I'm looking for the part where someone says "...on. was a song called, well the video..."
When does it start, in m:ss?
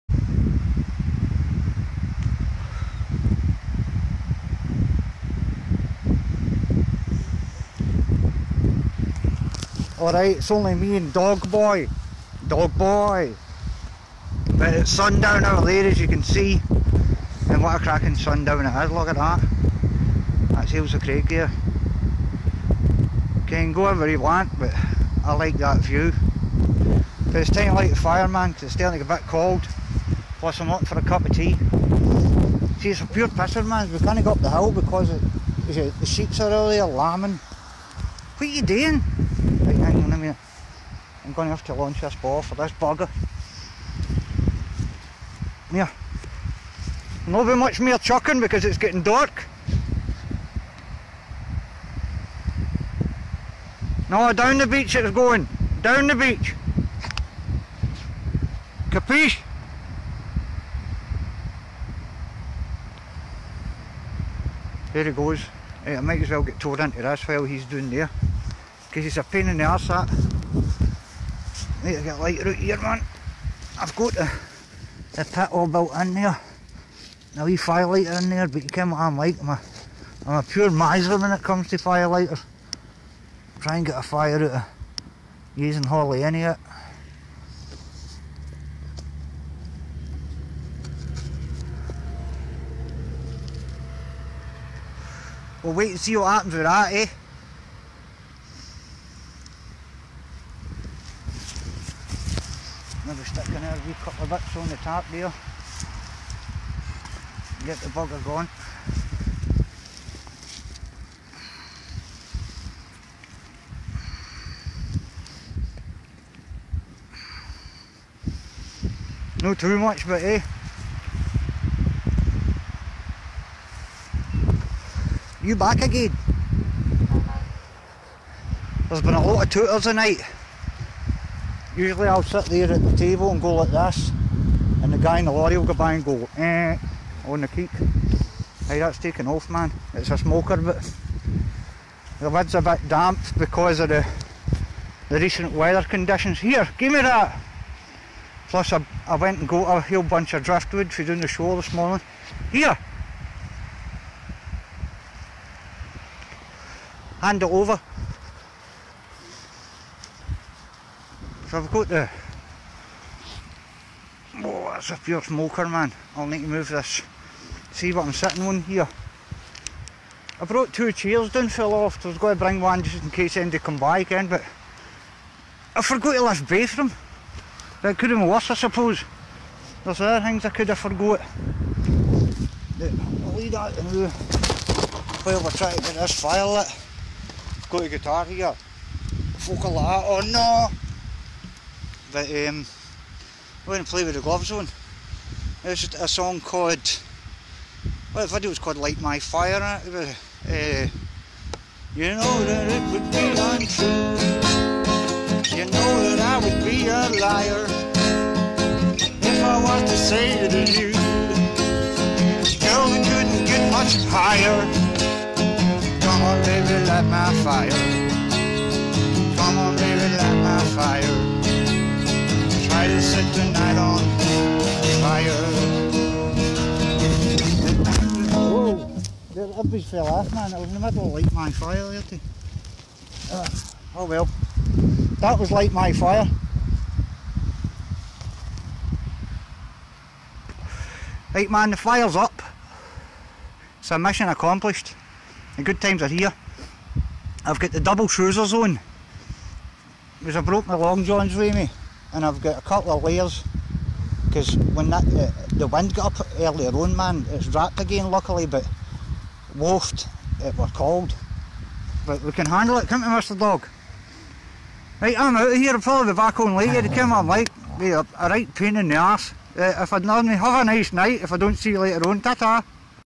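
3:14.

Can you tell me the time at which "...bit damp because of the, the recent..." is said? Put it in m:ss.
2:22.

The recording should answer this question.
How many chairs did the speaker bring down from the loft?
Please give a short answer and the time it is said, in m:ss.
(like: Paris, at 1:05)
2, at 2:50.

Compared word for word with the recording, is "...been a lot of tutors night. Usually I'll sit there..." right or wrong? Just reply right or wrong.
wrong.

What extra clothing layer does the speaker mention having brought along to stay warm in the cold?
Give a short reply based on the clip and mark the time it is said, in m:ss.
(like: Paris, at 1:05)
Long johns, at 4:10.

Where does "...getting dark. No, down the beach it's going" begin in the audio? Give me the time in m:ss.
0:48.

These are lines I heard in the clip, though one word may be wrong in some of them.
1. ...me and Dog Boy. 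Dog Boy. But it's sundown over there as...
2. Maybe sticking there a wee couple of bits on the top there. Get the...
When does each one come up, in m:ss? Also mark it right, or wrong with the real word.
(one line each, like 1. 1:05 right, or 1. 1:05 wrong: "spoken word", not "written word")
1. 0:10 right
2. 1:43 right.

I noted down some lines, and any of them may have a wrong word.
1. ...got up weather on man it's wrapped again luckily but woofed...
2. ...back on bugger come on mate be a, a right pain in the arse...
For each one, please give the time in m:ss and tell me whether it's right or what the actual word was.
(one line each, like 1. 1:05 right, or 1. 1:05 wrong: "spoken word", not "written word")
1. 4:15 wrong: "earlier", not "weather"
2. 4:26 wrong: "later", not "bugger".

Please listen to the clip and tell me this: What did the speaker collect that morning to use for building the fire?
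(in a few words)
Driftwood.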